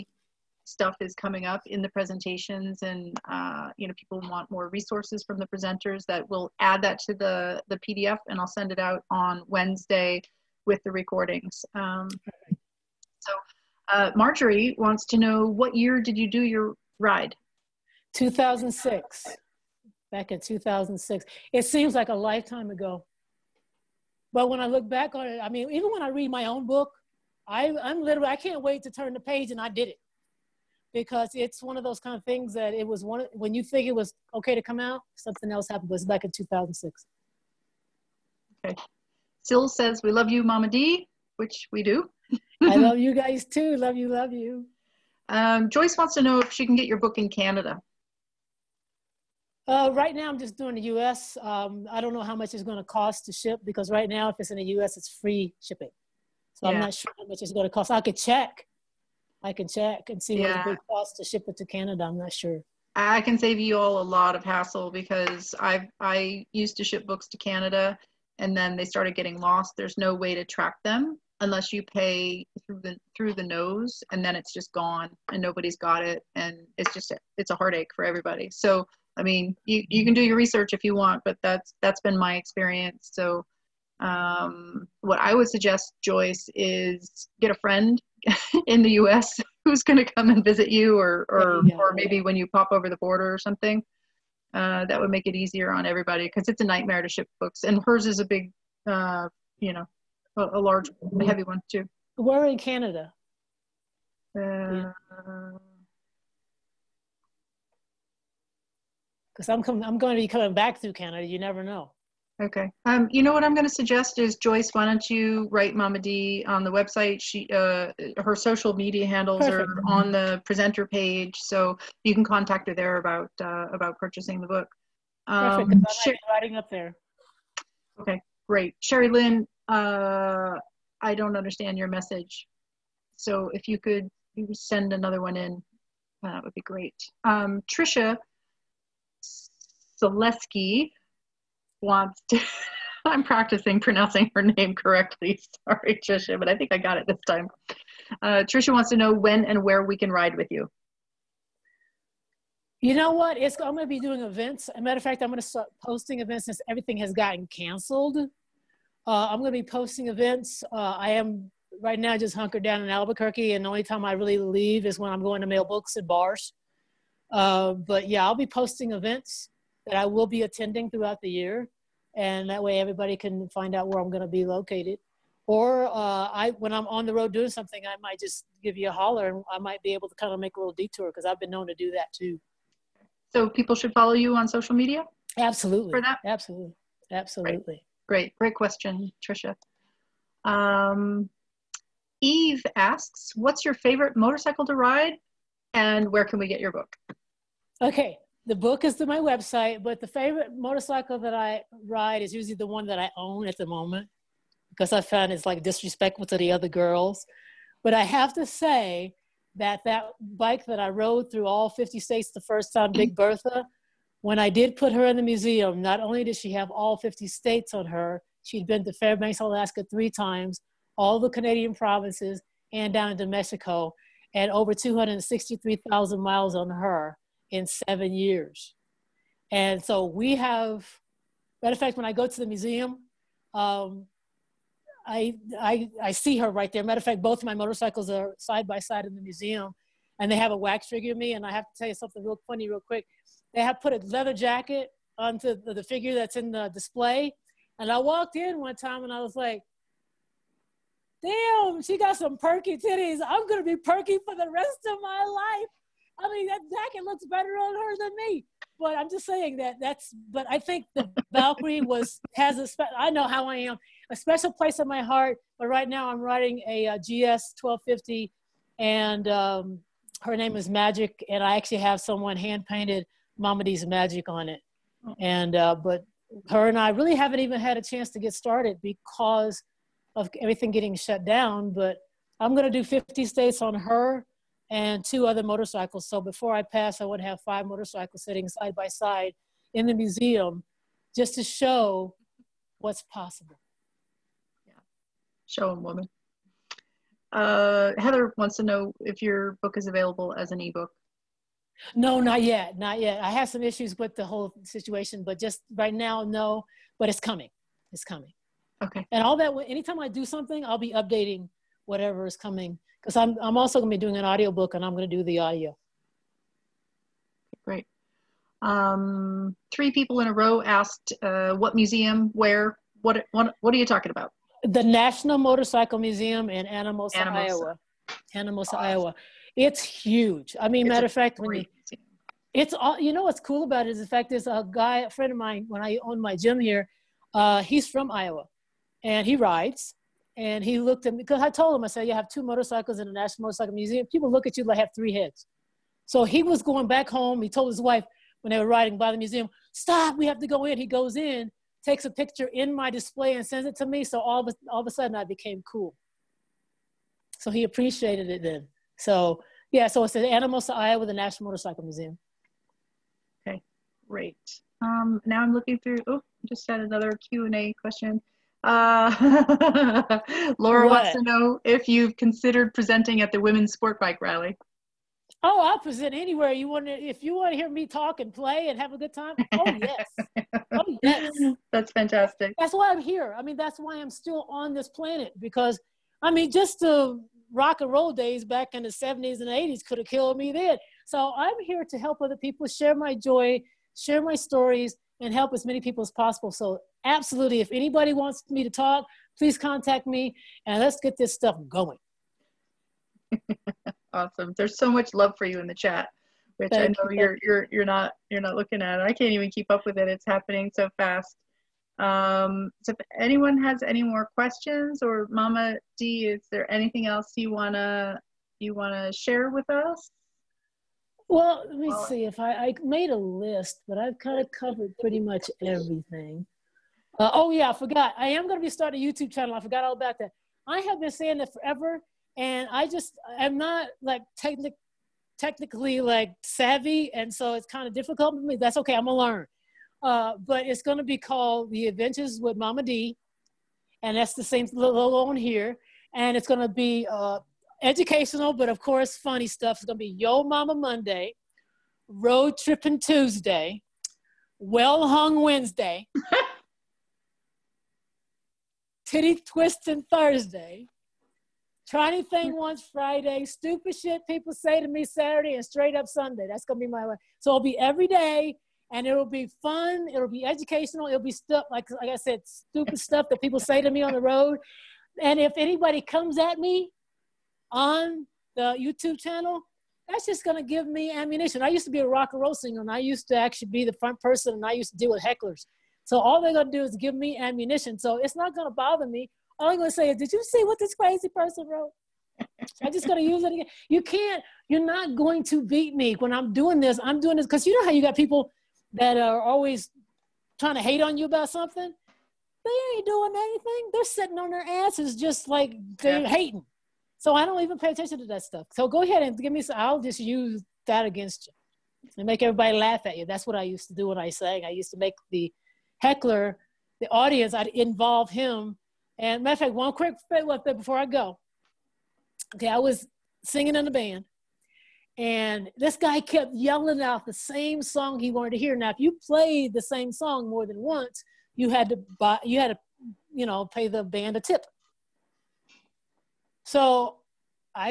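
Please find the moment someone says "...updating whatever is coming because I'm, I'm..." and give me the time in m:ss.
5:10.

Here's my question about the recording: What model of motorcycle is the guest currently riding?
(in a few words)
GS 1250.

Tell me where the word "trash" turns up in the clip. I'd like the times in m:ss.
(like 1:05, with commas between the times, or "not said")
not said.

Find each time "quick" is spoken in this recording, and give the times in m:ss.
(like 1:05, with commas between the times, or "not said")
4:02, 8:39.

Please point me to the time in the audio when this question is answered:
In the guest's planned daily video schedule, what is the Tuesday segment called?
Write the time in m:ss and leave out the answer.
7:32.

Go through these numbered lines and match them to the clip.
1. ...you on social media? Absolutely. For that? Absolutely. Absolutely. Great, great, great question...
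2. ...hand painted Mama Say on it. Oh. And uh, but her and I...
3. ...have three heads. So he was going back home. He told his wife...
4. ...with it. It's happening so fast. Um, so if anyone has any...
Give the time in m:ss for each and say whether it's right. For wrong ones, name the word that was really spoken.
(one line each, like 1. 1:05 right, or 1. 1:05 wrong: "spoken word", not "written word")
1. 3:04 right
2. 4:32 wrong: "Magic", not "Say"
3. 5:44 right
4. 6:49 right.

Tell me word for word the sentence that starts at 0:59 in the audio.
I can check and see yeah.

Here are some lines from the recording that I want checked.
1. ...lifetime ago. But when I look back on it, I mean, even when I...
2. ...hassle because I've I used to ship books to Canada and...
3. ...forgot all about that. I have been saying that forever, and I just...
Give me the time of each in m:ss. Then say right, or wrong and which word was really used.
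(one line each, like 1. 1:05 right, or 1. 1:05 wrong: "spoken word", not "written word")
1. 0:22 right
2. 1:04 right
3. 7:09 right.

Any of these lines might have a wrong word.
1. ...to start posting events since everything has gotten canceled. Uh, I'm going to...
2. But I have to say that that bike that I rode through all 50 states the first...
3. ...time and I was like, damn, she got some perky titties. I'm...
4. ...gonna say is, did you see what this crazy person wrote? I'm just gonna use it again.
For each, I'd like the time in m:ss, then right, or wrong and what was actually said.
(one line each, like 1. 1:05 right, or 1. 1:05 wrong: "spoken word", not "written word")
1. 2:35 right
2. 3:27 right
3. 4:08 right
4. 8:09 right.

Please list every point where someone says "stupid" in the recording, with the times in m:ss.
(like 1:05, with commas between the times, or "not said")
7:43, 7:52.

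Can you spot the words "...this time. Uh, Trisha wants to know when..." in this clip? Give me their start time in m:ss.
2:27.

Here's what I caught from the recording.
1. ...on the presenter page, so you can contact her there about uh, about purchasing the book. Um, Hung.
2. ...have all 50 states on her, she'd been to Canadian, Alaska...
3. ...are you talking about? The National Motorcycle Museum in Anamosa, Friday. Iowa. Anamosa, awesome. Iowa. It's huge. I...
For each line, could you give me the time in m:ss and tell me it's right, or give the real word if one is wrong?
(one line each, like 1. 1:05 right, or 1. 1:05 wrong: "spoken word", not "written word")
1. 1:59 wrong: "Perfect", not "Hung"
2. 3:36 wrong: "Fairbanks", not "Canadian"
3. 5:23 wrong: "Anamosa", not "Friday".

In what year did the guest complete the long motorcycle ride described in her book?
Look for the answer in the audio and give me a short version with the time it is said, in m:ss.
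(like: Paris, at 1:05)
2006, at 0:18.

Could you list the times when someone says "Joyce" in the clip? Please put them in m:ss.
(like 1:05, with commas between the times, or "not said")
0:45, 1:26, 1:54.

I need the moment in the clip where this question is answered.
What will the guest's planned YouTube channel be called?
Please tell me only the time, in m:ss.
7:21.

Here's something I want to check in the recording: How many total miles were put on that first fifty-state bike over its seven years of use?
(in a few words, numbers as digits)
263,000.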